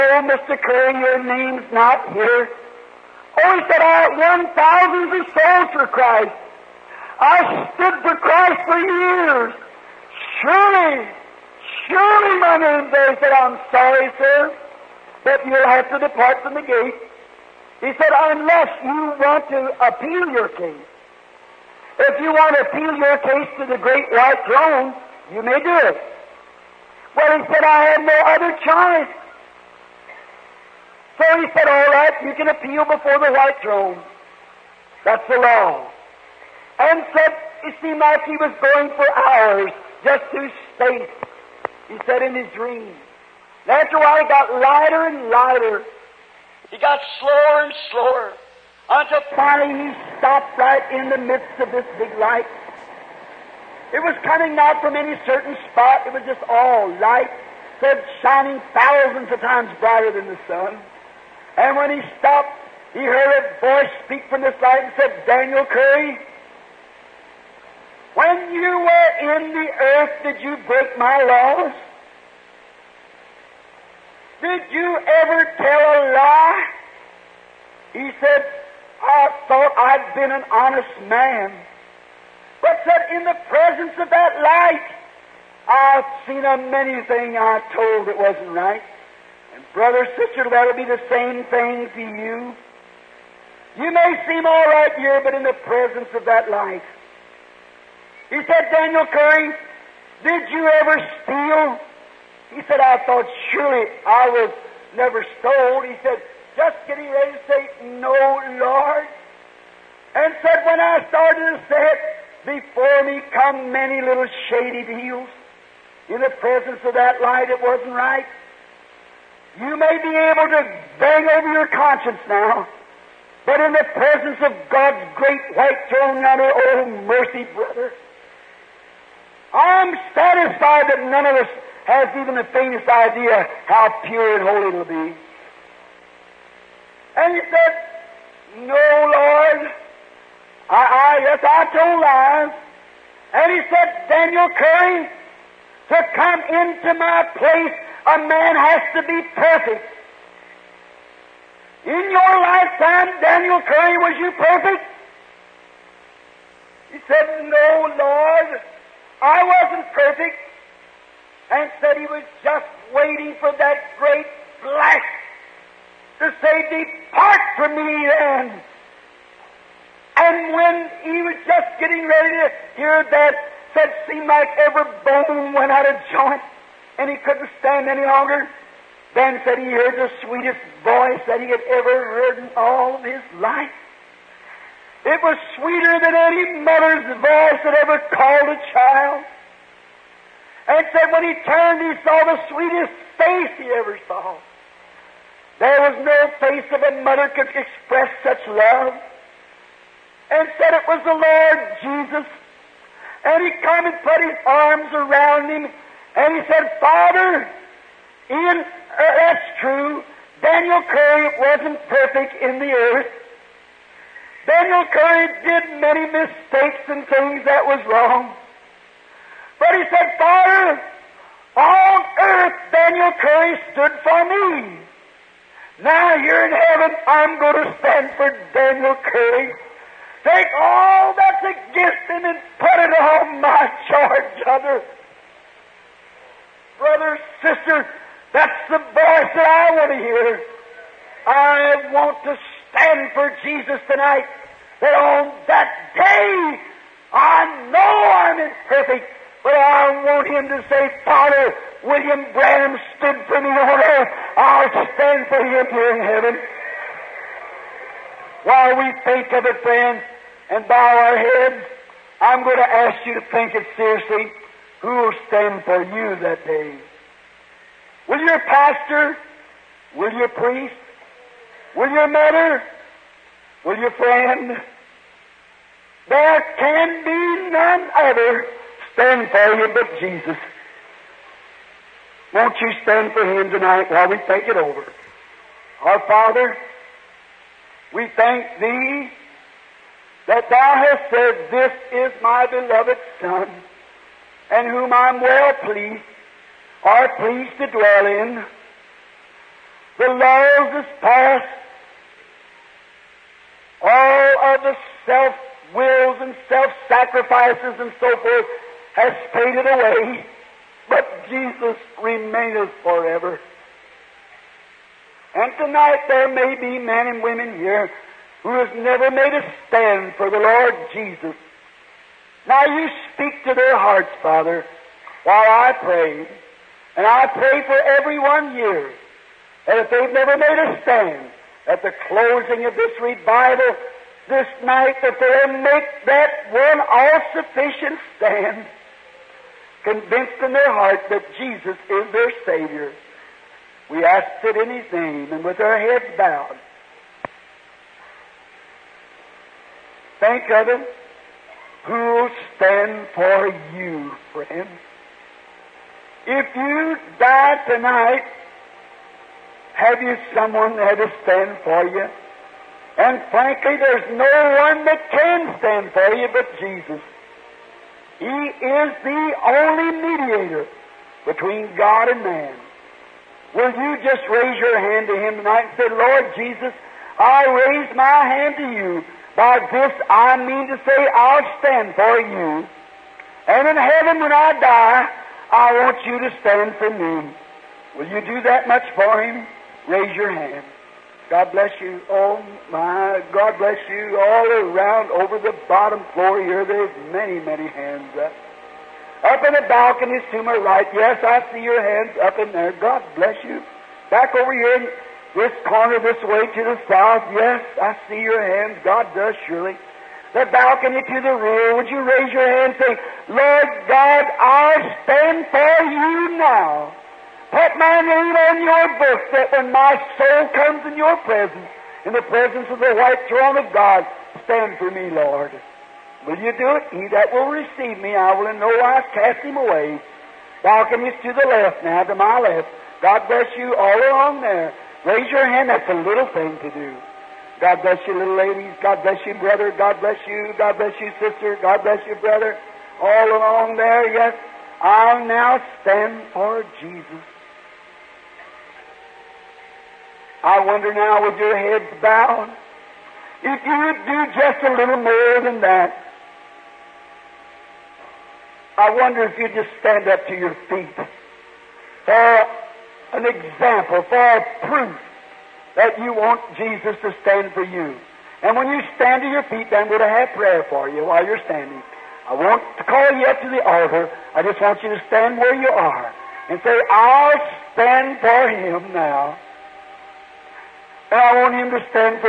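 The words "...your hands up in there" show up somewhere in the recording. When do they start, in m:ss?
6:41.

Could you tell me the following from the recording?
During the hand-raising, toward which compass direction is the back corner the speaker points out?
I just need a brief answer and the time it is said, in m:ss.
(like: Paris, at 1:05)
South, at 6:46.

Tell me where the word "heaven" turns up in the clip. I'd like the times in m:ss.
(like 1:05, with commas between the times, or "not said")
3:46, 4:16, 6:23.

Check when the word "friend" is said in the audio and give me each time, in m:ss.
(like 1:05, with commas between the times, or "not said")
4:19, 4:33, 5:54.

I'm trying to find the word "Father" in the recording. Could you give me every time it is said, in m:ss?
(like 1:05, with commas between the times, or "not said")
3:26, 3:40, 4:11, 4:46, 5:24.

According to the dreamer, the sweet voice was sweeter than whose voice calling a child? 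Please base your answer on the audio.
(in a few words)
A mother's.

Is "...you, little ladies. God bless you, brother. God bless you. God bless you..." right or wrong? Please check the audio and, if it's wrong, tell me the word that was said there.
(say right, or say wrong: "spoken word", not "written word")
right.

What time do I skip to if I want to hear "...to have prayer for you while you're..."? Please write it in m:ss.
7:50.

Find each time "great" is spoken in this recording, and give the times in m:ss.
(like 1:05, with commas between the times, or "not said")
0:23, 2:05, 2:43.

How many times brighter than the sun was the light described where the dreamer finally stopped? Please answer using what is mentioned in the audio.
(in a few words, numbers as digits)
Thousands of times.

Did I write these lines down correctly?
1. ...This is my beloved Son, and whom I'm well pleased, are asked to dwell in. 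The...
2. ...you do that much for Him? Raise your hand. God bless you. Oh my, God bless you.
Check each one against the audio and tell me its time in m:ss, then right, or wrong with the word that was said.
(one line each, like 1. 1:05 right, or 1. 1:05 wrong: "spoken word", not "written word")
1. 4:51 wrong: "pleased", not "asked"
2. 6:28 right.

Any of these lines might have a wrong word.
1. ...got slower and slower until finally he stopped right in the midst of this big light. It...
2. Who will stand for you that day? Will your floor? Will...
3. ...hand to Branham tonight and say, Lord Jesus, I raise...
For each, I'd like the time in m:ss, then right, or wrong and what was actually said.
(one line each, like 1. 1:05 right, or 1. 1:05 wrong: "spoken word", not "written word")
1. 0:46 right
2. 4:24 wrong: "pastor", not "floor"
3. 6:14 wrong: "Him", not "Branham".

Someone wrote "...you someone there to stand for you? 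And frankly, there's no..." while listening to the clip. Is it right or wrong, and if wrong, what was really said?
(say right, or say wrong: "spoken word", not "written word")
right.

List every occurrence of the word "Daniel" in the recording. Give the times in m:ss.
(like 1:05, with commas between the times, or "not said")
1:05, 1:38, 2:24, 2:33, 3:30, 3:34, 3:42, 3:48.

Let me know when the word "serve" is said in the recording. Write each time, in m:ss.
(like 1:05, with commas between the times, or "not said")
not said.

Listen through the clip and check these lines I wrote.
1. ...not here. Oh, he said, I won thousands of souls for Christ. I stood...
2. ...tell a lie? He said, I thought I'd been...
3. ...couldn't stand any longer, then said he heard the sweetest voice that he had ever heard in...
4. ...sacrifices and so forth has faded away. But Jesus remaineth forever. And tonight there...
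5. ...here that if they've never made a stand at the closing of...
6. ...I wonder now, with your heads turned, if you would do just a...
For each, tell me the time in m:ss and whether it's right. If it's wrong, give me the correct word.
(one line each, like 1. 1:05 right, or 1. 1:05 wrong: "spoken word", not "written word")
1. 0:01 right
2. 1:15 right
3. 2:57 right
4. 5:06 right
5. 5:28 right
6. 7:30 wrong: "bowed", not "turned".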